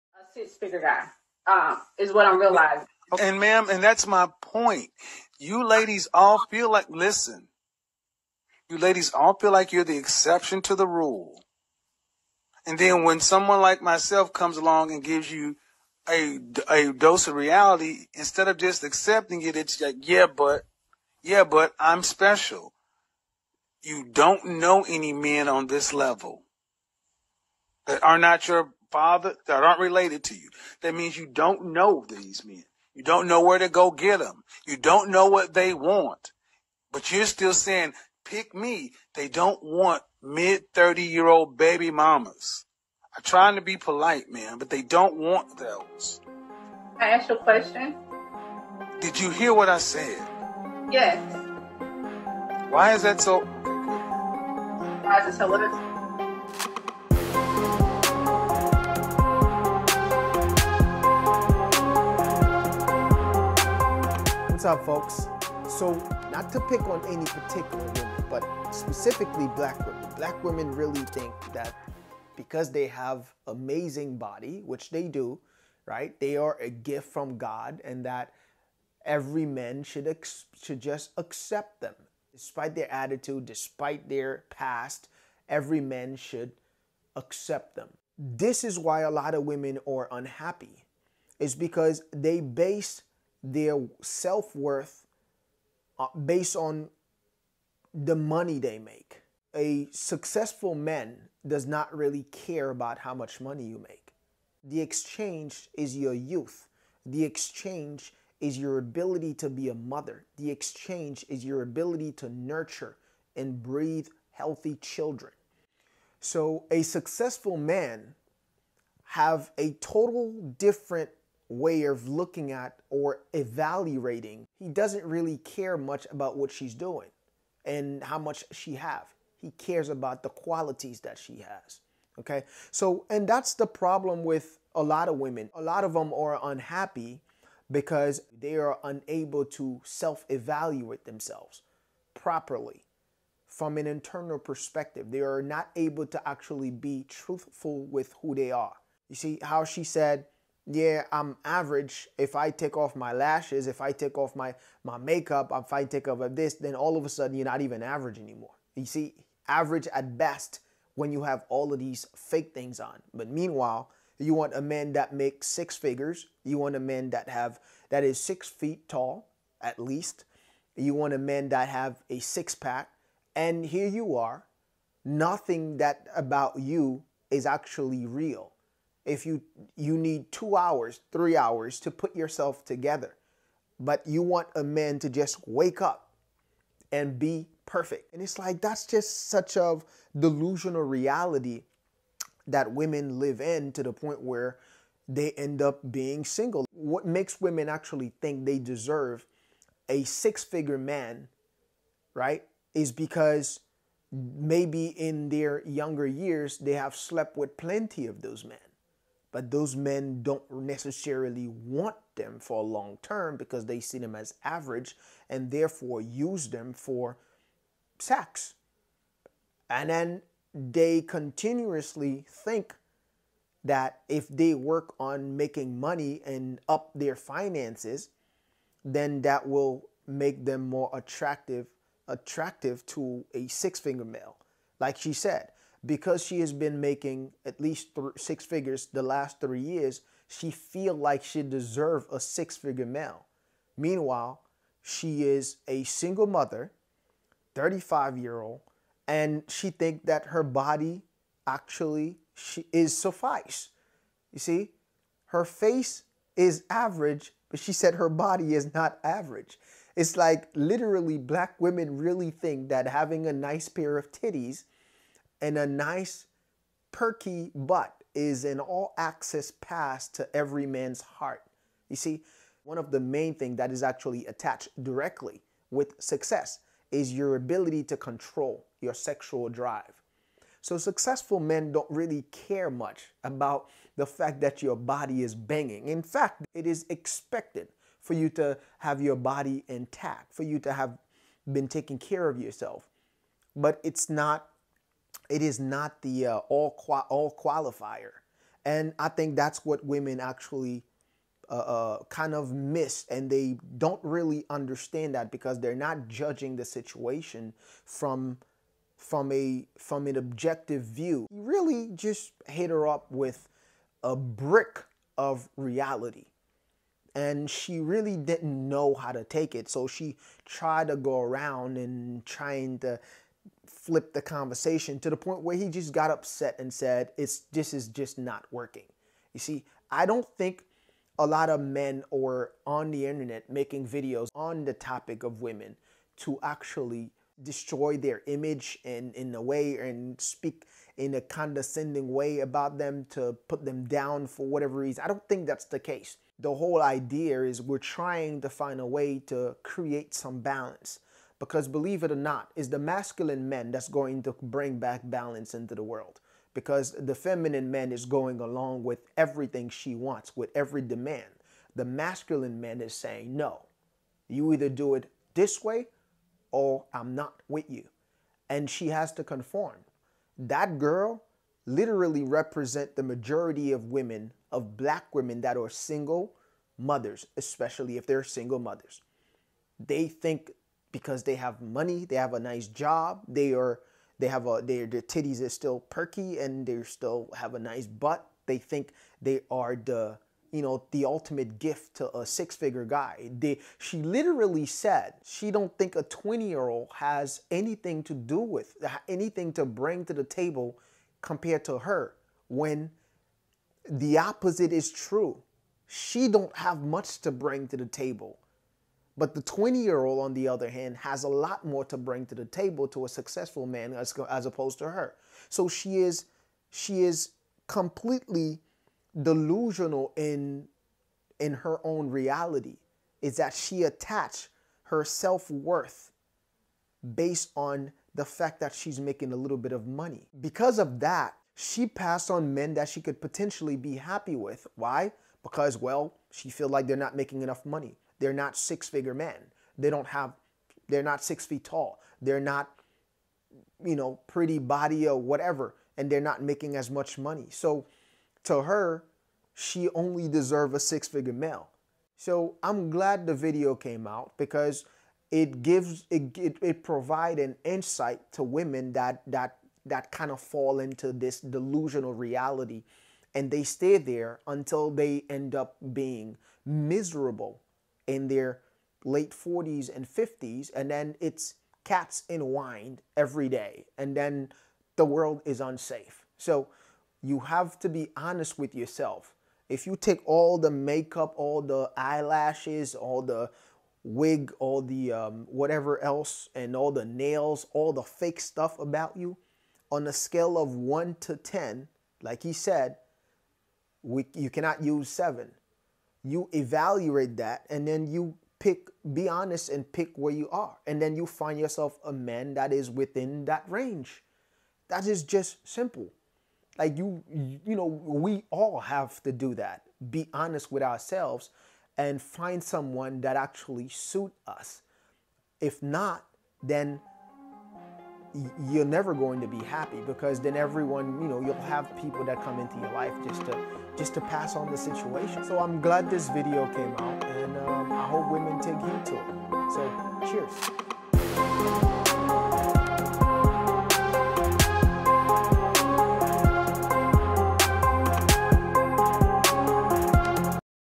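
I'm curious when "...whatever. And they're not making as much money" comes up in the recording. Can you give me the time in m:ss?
7:25.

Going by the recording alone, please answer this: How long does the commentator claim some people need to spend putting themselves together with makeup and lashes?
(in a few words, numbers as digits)
2 hours, 3 hours.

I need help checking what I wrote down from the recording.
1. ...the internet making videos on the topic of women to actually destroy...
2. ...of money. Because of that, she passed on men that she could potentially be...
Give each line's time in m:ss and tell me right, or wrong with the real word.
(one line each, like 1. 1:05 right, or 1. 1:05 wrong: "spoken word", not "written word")
1. 5:32 right
2. 7:09 right.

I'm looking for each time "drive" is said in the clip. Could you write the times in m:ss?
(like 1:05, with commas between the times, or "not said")
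4:39.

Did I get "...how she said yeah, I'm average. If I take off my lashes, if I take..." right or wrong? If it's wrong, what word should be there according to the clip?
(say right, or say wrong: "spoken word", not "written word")
right.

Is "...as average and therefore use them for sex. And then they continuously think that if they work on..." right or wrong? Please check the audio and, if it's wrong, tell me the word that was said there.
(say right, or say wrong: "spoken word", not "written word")
right.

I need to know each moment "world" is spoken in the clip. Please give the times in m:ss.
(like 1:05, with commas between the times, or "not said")
5:55, 7:55.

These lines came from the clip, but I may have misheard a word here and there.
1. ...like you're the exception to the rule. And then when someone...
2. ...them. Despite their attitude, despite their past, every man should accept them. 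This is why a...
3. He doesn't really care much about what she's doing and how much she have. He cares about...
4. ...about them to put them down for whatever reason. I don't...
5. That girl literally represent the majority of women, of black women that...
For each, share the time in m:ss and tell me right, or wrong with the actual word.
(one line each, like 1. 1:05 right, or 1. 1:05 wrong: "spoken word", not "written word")
1. 0:09 right
2. 1:21 right
3. 2:04 right
4. 5:42 right
5. 6:10 right.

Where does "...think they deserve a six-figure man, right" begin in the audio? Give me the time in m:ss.
3:18.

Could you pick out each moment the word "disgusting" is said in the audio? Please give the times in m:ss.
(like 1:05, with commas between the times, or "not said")
not said.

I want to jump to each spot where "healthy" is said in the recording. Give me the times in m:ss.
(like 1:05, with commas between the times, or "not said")
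1:54.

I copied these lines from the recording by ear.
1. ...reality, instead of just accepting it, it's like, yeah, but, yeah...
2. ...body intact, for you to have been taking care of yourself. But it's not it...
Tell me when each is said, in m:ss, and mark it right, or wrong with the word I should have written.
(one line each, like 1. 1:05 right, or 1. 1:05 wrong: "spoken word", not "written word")
1. 0:17 right
2. 4:49 right.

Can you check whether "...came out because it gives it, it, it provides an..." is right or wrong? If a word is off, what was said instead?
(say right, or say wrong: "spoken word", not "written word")
right.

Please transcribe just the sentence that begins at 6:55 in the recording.
So she is, she is completely delusional in, in her own reality.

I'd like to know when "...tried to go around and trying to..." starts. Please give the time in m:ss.
5:20.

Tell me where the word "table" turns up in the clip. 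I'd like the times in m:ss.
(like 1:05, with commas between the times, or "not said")
6:40, 6:47, 6:52.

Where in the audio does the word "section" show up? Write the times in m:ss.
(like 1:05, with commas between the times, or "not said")
not said.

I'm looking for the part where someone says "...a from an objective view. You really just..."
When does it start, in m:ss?
5:09.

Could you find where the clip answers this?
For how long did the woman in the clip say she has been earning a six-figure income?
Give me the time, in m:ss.
3:58.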